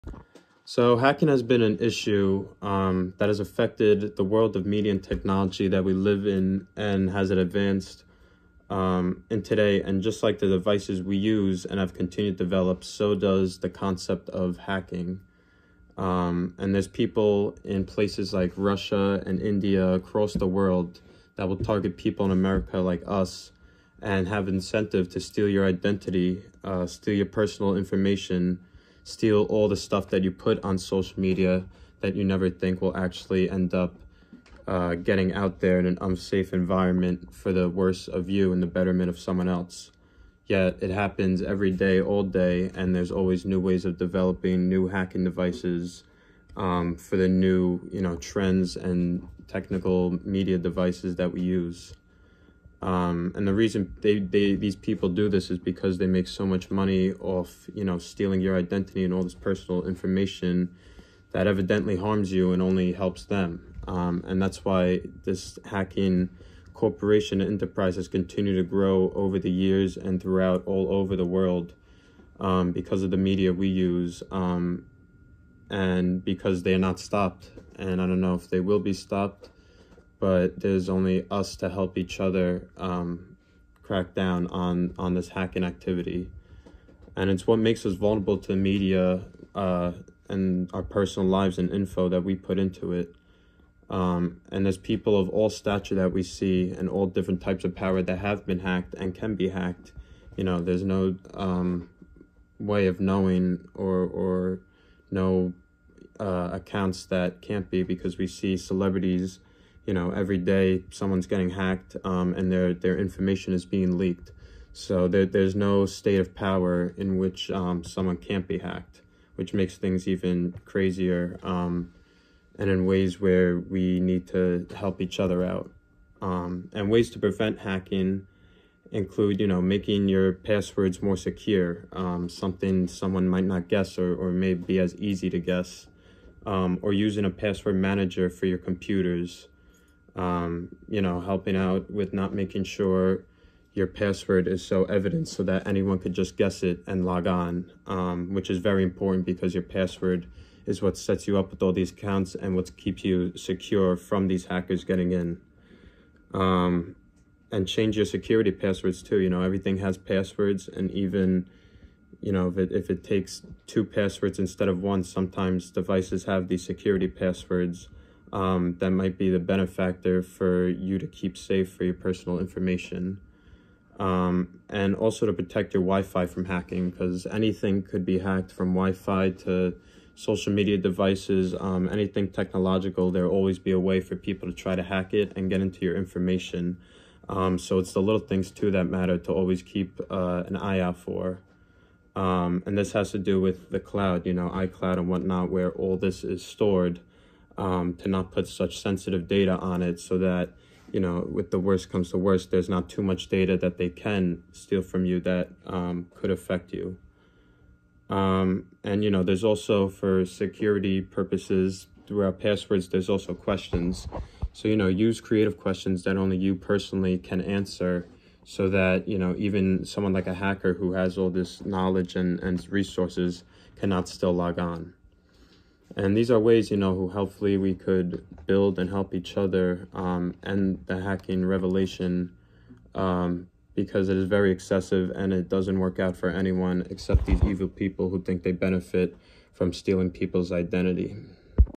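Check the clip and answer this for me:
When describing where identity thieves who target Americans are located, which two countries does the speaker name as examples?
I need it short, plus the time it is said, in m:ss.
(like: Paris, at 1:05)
Russia and India, at 0:18.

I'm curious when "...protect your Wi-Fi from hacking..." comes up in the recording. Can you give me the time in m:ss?
2:55.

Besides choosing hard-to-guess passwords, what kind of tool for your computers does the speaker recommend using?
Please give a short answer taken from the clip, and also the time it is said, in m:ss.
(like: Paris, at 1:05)
password manager, at 2:17.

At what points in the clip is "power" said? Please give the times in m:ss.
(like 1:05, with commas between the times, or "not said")
1:37, 1:56.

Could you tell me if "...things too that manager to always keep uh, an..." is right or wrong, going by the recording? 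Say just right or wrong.
wrong.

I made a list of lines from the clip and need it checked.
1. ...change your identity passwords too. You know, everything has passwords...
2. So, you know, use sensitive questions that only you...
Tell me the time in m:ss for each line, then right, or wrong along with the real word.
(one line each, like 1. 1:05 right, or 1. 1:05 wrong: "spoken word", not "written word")
1. 2:37 wrong: "security", not "identity"
2. 3:34 wrong: "creative", not "sensitive".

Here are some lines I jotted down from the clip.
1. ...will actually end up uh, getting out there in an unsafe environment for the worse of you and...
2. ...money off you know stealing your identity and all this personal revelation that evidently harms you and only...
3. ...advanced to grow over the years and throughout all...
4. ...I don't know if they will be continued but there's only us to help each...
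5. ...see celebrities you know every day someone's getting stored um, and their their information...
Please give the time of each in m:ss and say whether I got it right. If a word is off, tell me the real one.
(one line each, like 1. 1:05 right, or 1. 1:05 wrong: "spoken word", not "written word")
1. 0:32 right
2. 0:56 wrong: "information", not "revelation"
3. 1:08 wrong: "continued", not "advanced"
4. 1:18 wrong: "stopped", not "continued"
5. 1:48 wrong: "hacked", not "stored".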